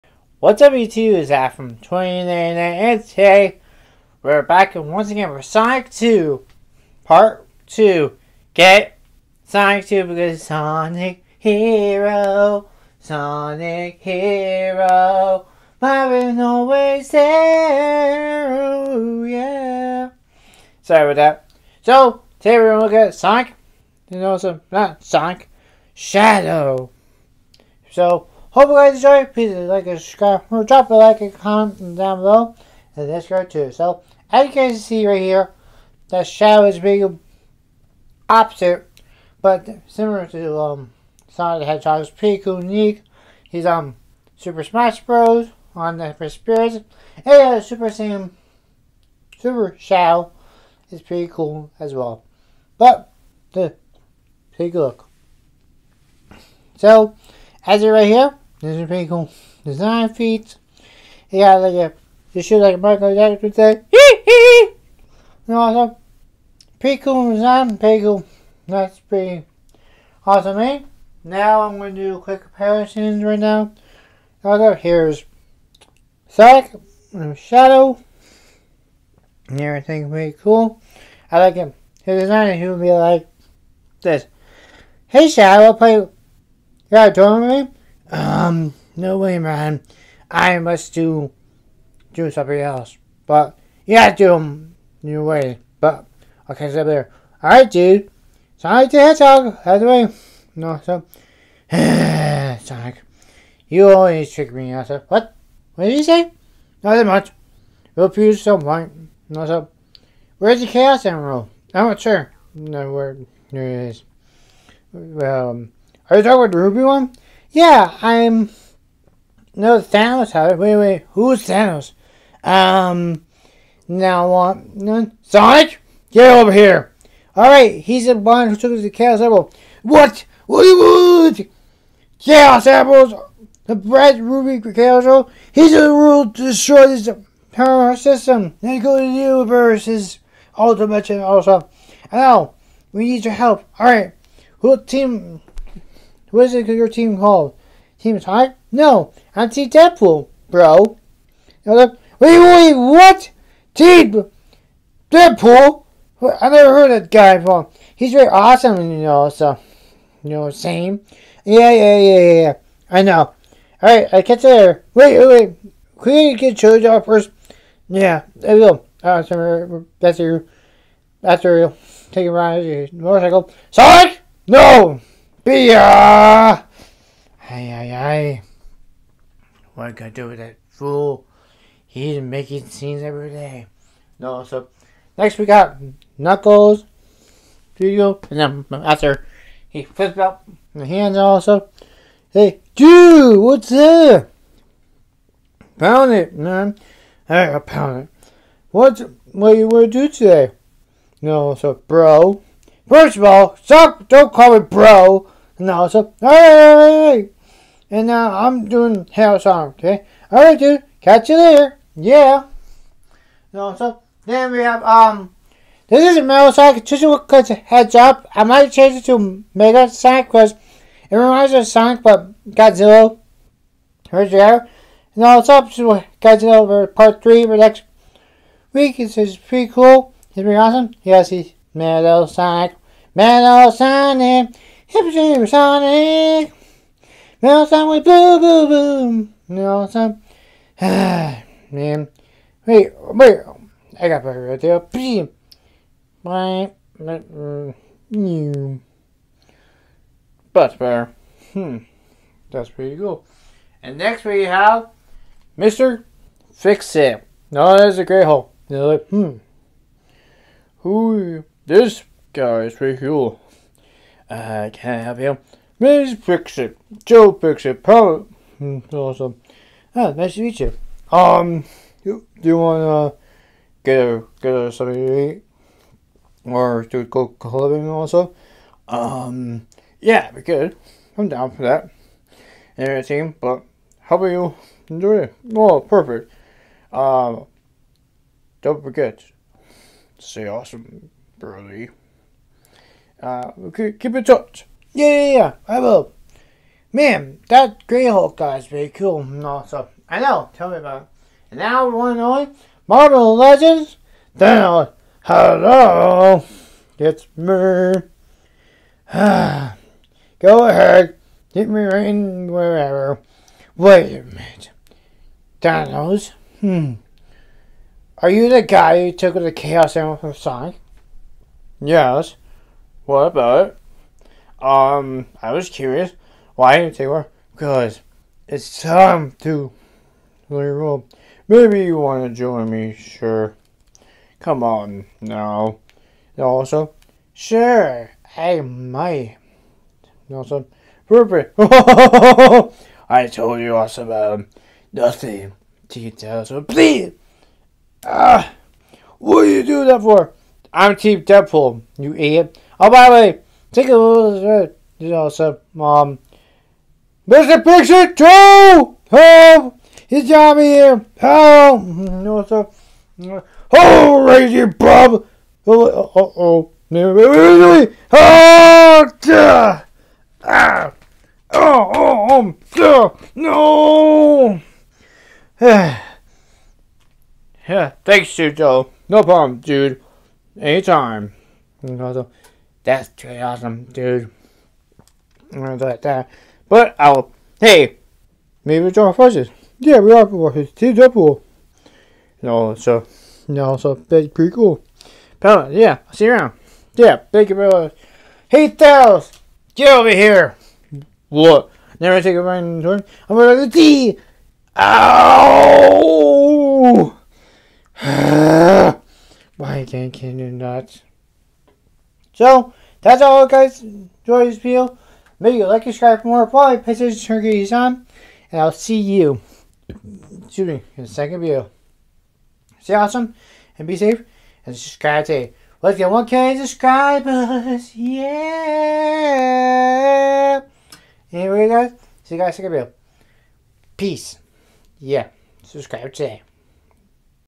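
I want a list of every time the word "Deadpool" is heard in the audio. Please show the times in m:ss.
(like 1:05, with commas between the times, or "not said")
2:29, 2:35, 5:46, 5:51, 6:30.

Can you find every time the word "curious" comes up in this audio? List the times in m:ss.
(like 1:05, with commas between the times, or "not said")
5:25.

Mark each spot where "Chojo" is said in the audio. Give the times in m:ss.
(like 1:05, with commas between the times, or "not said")
2:46.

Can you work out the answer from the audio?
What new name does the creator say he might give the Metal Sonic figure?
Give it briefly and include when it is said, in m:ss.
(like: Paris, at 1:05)
Mega Sonic, at 3:39.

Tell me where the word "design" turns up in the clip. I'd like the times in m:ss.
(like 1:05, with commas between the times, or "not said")
0:59, 1:07, 1:22.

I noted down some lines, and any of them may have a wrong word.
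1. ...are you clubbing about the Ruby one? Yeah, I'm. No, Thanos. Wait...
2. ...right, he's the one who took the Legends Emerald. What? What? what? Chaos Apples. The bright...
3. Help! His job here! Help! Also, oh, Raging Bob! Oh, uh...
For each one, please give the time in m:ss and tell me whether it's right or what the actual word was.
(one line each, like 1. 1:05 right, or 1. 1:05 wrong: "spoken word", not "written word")
1. 1:56 wrong: "talking", not "clubbing"
2. 2:07 wrong: "Chaos", not "Legends"
3. 5:59 right.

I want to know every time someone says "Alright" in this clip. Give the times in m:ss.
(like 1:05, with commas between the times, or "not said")
2:43, 3:30.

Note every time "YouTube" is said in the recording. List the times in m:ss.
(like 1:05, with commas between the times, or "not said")
0:00.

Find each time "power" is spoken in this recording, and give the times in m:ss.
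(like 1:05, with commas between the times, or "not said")
2:17, 4:27.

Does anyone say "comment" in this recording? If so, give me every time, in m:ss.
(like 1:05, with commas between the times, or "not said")
0:31.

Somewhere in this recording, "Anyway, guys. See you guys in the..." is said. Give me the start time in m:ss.
7:11.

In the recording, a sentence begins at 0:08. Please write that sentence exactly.
Get Sonic 2 because Sonic Hero, Sonic Hero, Marvin always there.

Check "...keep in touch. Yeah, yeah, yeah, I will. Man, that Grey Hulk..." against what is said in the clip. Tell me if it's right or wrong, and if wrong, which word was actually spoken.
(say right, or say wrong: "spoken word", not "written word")
right.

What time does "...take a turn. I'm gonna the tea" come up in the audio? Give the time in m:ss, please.
6:42.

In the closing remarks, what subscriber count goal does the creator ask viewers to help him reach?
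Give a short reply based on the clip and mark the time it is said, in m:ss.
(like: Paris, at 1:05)
1K, at 7:06.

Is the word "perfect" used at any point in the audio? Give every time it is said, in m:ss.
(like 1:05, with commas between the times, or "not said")
4:45, 5:41.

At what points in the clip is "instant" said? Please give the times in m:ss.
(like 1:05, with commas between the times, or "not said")
not said.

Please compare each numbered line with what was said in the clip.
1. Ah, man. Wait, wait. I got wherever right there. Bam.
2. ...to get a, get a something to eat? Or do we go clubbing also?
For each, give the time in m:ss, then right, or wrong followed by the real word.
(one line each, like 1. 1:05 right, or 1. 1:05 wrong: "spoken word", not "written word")
1. 4:00 wrong: "better", not "wherever"
2. 4:33 right.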